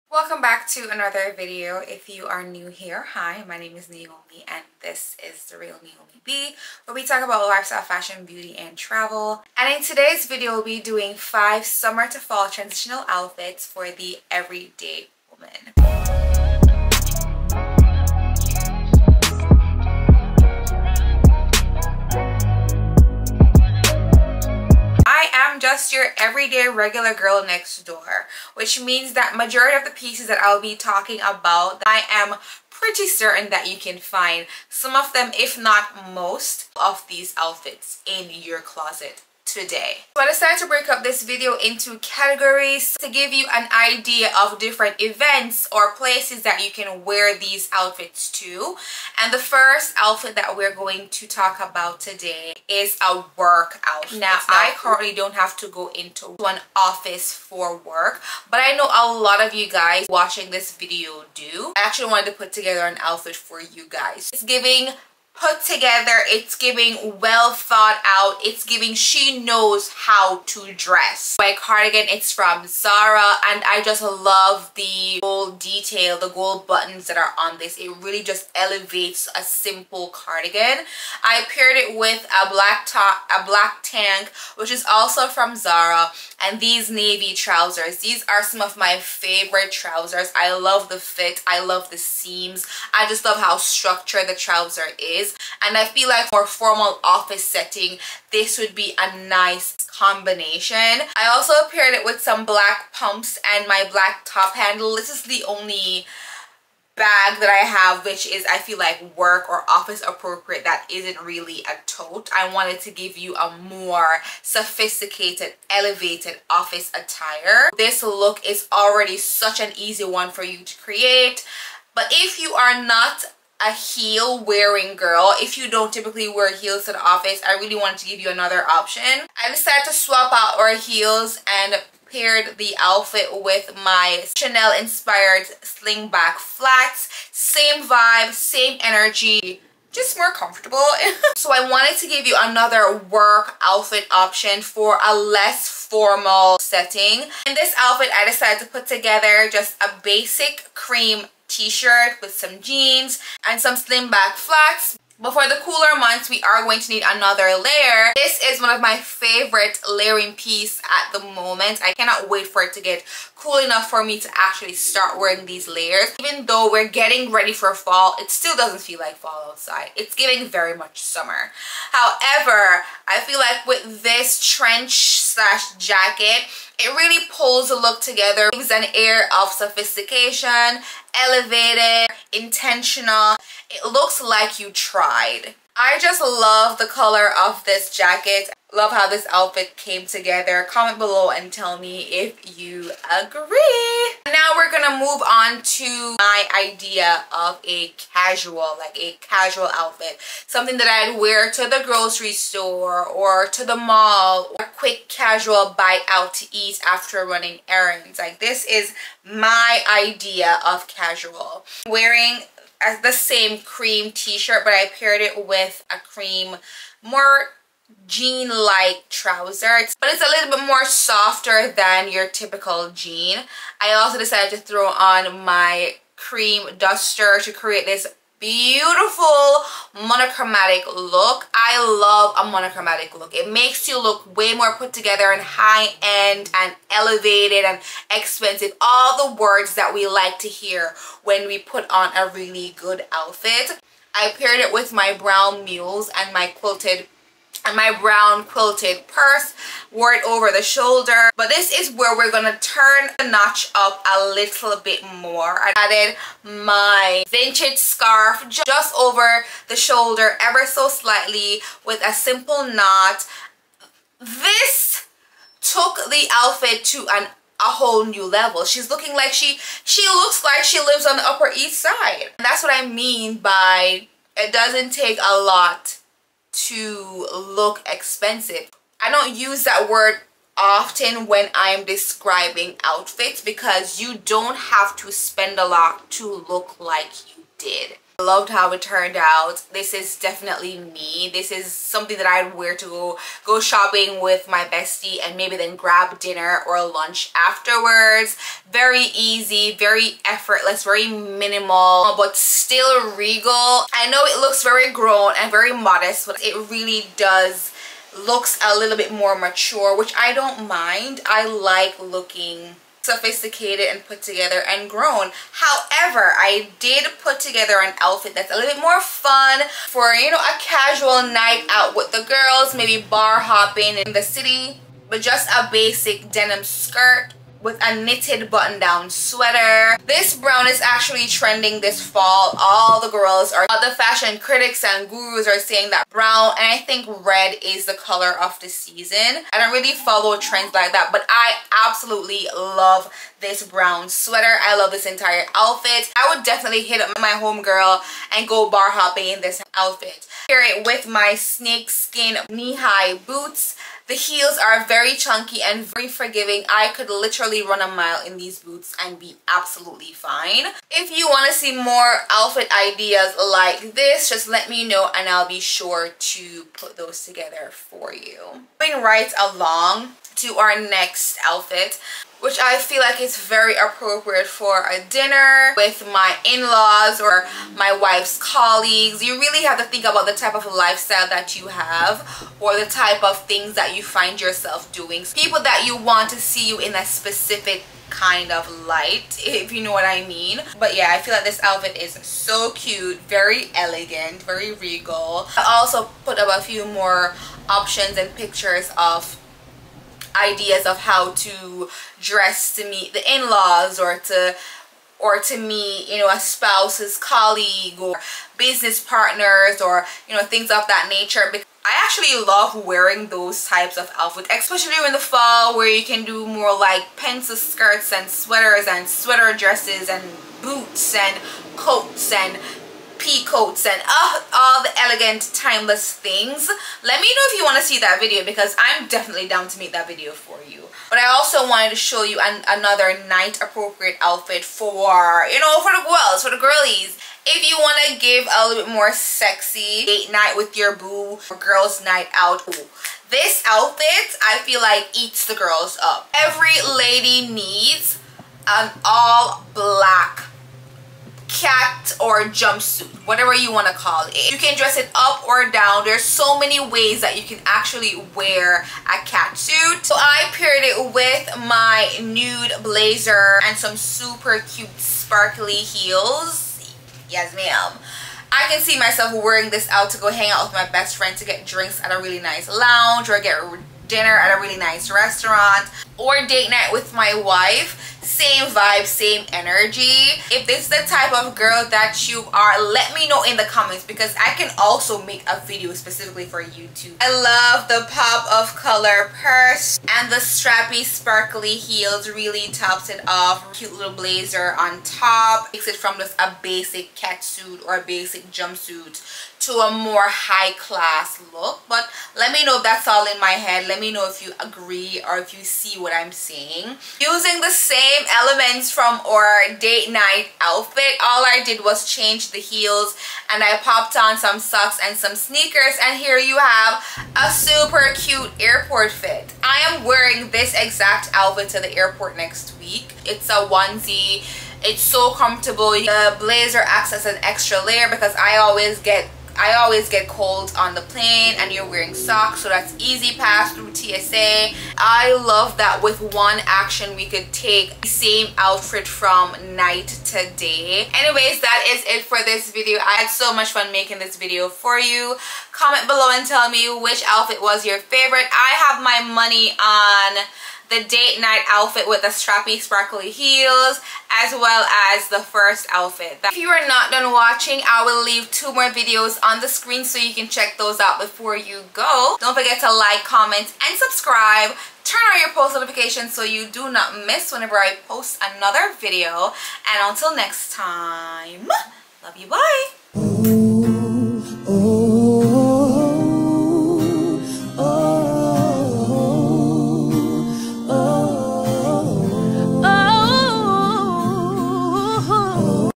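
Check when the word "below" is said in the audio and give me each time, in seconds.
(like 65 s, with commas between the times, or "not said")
190 s, 546 s.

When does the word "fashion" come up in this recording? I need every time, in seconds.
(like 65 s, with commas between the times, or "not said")
7 s, 333 s.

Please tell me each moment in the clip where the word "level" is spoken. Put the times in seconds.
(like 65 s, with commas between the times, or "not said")
268 s.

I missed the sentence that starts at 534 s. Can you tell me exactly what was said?
I love that with one action we could take the same outfit from night to day.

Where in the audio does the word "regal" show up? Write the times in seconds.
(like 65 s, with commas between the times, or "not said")
303 s, 394 s.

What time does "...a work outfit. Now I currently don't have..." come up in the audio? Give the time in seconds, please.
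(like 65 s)
53 s.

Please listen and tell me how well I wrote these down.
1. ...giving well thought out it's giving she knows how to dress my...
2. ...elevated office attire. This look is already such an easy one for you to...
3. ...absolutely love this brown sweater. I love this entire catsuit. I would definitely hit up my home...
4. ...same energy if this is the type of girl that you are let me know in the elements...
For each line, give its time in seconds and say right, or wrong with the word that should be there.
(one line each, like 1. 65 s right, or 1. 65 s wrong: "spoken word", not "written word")
1. 66 s right
2. 115 s right
3. 341 s wrong: "outfit", not "catsuit"
4. 479 s wrong: "comments", not "elements".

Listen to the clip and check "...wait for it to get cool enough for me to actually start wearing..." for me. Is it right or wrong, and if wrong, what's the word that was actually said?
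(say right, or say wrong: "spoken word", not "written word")
right.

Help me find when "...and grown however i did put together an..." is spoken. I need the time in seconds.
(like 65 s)
314 s.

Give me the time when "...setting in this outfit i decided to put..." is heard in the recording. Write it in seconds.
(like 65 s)
146 s.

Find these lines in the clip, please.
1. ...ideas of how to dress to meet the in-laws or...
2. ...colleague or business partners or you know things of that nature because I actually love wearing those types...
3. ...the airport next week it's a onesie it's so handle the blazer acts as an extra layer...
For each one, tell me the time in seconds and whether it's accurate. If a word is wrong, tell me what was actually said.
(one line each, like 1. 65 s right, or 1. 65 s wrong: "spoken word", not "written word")
1. 400 s right
2. 407 s right
3. 521 s wrong: "comfortable", not "handle".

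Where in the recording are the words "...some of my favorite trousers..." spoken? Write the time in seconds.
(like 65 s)
88 s.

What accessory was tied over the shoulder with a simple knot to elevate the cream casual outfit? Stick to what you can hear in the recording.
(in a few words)
Vintage scarf.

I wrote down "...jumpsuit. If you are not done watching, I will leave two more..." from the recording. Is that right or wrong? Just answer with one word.
wrong.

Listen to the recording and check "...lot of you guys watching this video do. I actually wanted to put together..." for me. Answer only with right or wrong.
right.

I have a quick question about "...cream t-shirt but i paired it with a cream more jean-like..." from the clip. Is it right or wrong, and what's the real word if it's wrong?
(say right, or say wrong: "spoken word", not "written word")
right.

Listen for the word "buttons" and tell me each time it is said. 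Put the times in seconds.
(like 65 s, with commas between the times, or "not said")
76 s, 328 s.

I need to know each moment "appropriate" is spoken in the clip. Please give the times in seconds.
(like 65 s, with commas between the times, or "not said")
110 s, 373 s, 433 s.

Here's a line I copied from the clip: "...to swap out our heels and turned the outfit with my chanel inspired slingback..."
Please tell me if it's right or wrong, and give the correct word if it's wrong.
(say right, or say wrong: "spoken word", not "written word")
wrong: "paired", not "turned".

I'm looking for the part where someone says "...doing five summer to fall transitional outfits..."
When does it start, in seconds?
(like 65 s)
10 s.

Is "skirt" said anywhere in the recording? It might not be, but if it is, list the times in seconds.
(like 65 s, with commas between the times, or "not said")
326 s, 417 s.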